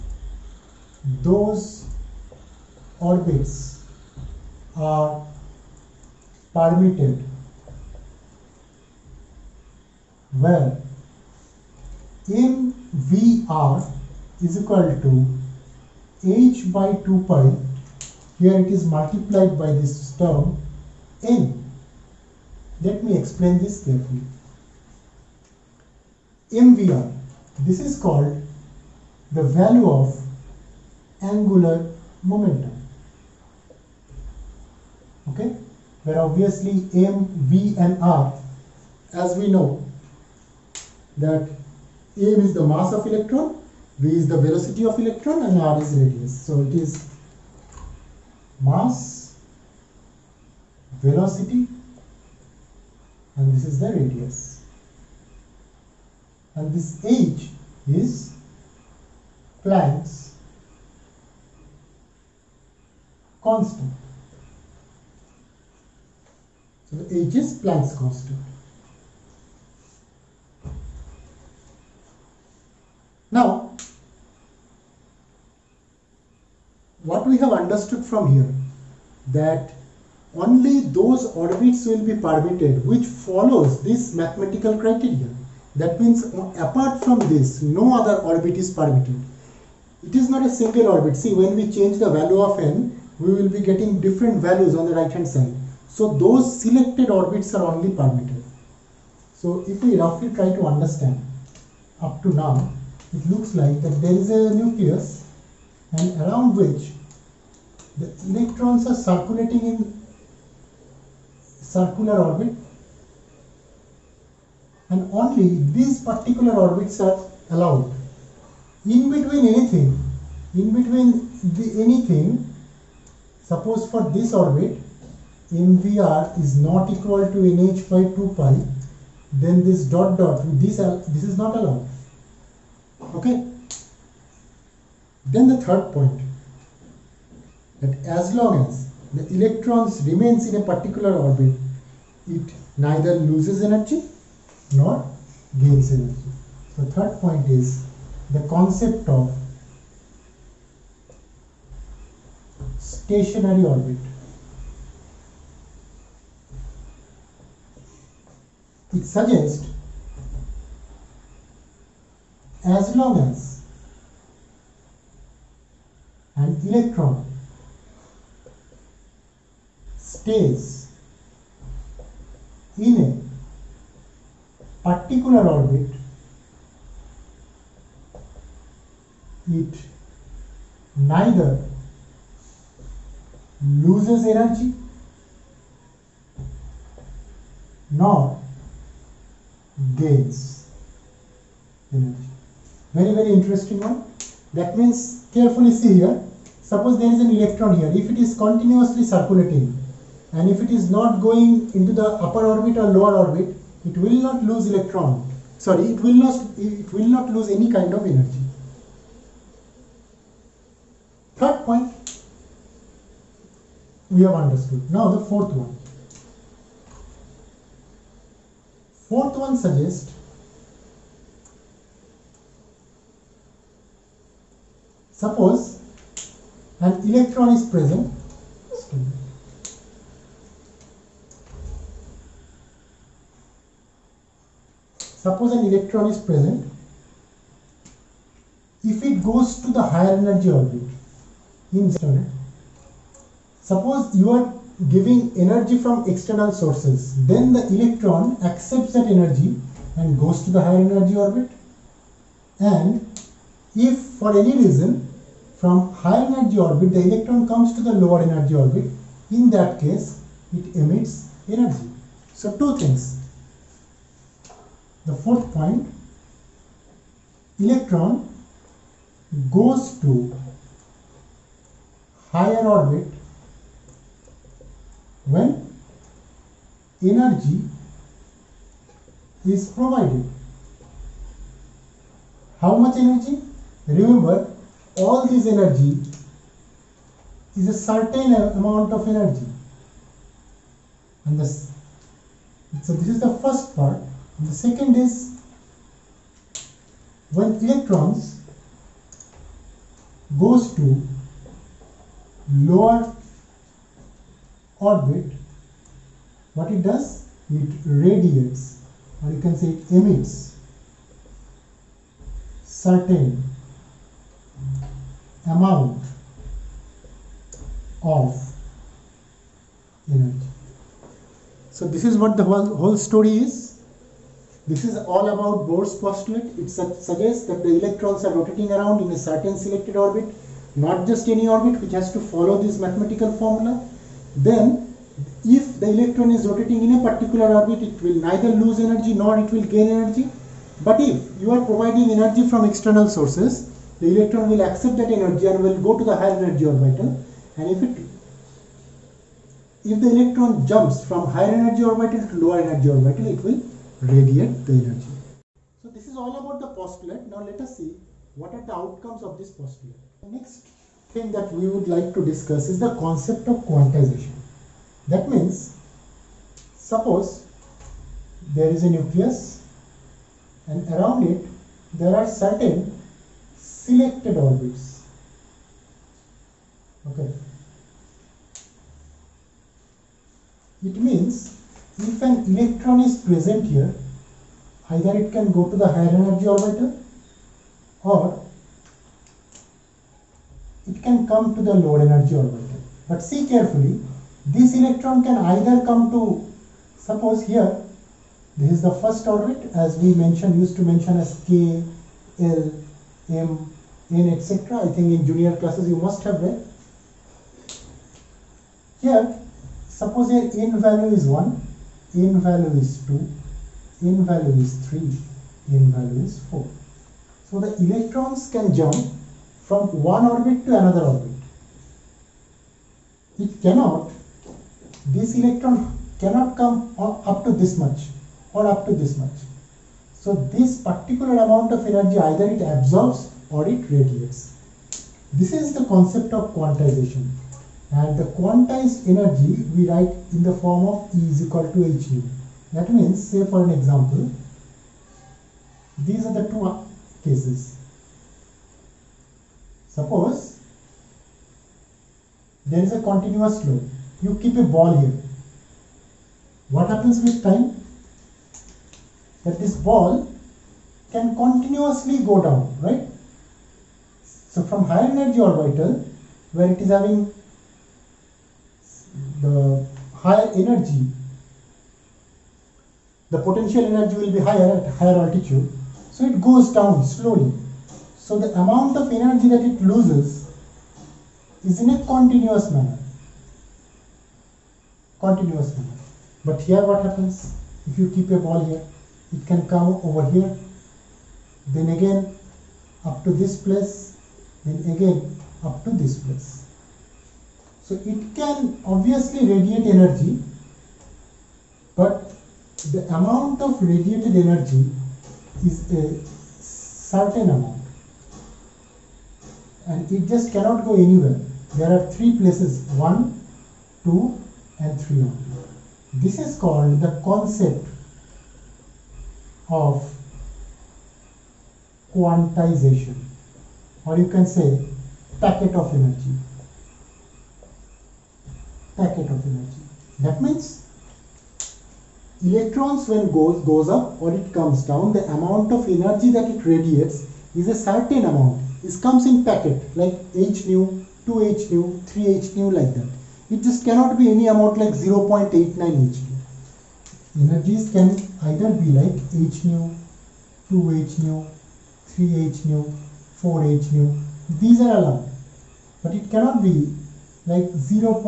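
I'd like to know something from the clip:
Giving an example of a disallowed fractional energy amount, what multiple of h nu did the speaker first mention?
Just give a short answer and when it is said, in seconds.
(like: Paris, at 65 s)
0.89, at 544 s.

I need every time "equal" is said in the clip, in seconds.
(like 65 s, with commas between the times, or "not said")
14 s, 126 s, 441 s.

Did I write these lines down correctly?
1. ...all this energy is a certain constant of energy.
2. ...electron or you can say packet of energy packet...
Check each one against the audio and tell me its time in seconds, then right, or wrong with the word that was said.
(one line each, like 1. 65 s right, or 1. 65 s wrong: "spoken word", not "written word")
1. 284 s wrong: "amount", not "constant"
2. 522 s wrong: "quantization", not "electron".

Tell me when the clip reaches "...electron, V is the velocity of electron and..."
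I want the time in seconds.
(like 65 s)
43 s.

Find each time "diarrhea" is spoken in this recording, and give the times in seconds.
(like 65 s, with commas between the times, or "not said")
not said.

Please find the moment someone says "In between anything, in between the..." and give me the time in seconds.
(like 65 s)
118 s.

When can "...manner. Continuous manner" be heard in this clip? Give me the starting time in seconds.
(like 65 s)
482 s.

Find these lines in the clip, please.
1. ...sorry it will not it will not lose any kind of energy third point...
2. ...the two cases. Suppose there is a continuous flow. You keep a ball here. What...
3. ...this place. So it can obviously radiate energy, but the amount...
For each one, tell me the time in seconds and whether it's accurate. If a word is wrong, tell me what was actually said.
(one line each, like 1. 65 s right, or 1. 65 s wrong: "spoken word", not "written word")
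1. 205 s right
2. 446 s right
3. 495 s right.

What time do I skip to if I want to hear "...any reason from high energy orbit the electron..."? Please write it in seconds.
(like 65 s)
254 s.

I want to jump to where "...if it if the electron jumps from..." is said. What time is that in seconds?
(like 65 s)
347 s.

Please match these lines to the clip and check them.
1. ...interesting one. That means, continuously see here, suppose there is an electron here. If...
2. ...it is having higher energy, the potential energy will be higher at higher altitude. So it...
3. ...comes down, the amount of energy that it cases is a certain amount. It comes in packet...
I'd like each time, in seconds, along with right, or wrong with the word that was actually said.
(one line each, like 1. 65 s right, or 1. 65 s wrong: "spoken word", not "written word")
1. 193 s wrong: "carefully", not "continuously"
2. 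466 s right
3. 534 s wrong: "radiates", not "cases".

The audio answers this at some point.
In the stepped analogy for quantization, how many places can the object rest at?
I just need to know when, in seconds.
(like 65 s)
512 s.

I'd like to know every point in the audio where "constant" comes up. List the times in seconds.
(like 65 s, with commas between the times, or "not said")
63 s, 67 s.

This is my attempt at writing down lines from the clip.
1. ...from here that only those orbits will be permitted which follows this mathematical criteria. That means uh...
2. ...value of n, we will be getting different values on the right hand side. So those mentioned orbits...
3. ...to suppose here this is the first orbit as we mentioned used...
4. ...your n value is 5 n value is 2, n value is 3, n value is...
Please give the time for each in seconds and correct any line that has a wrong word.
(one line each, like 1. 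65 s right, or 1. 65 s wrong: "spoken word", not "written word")
1. 78 s right
2. 92 s wrong: "selected", not "mentioned"
3. 396 s right
4. 410 s wrong: "1", not "5".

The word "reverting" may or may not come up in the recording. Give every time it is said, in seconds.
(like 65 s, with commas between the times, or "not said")
not said.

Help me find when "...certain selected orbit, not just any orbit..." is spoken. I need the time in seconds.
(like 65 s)
329 s.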